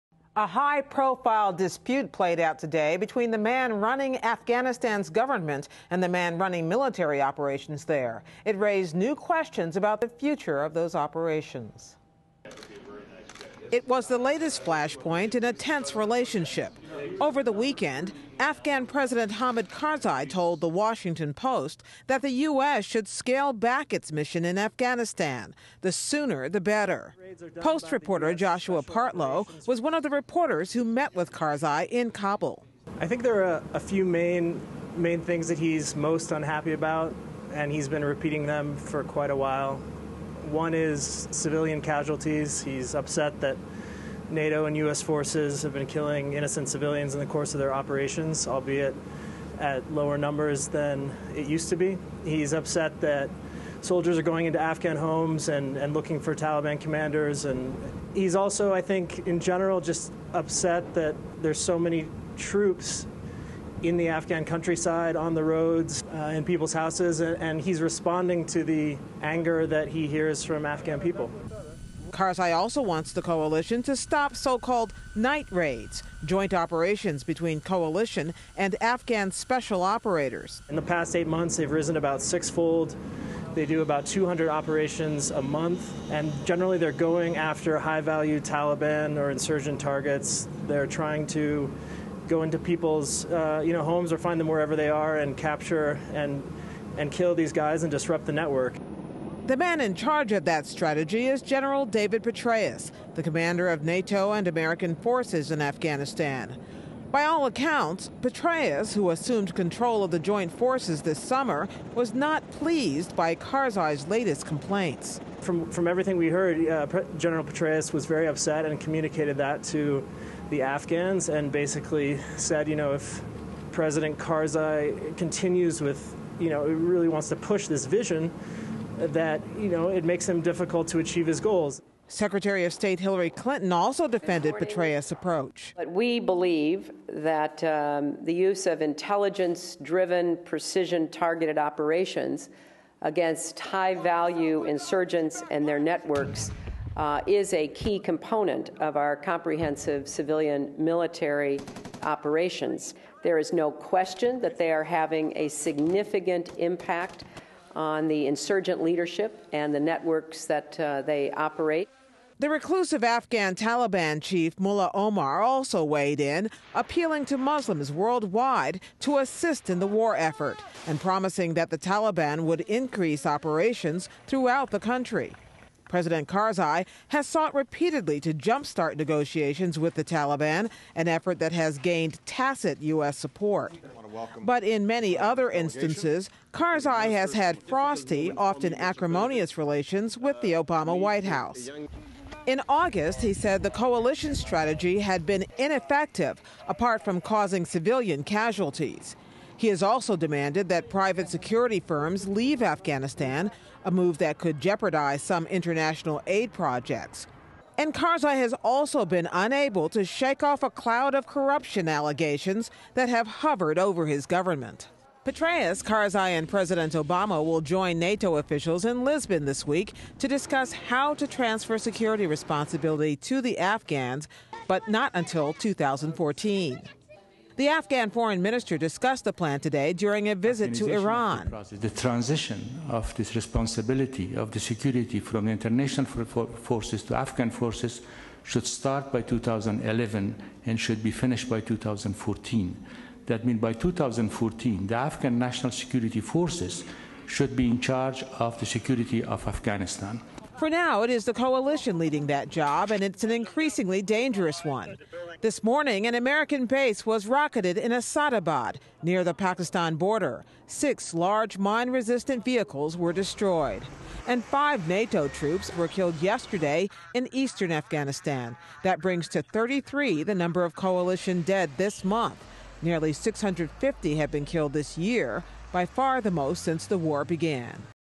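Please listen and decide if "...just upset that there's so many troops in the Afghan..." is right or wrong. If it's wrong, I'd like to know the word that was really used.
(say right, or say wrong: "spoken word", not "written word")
right.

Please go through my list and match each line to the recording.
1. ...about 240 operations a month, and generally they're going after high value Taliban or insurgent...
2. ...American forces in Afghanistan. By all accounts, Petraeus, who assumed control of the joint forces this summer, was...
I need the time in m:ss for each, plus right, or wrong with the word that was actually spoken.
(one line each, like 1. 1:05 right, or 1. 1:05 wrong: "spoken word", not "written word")
1. 1:23 wrong: "200", not "240"
2. 1:44 right.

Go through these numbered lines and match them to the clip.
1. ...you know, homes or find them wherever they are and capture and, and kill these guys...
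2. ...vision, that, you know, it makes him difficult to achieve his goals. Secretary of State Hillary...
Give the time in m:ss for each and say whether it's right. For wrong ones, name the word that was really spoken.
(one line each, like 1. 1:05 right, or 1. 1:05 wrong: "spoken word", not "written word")
1. 1:33 right
2. 2:07 right.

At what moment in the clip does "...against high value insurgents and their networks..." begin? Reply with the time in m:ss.
2:23.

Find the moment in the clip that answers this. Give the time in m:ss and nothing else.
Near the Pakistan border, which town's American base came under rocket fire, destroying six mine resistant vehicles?
4:17.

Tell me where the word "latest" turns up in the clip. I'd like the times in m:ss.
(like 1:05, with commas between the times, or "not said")
0:14, 1:54.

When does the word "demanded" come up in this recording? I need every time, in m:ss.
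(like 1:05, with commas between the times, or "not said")
3:20.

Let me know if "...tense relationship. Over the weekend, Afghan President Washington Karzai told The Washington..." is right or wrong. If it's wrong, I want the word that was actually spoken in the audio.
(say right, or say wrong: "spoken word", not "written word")
wrong: "Hamid", not "Washington".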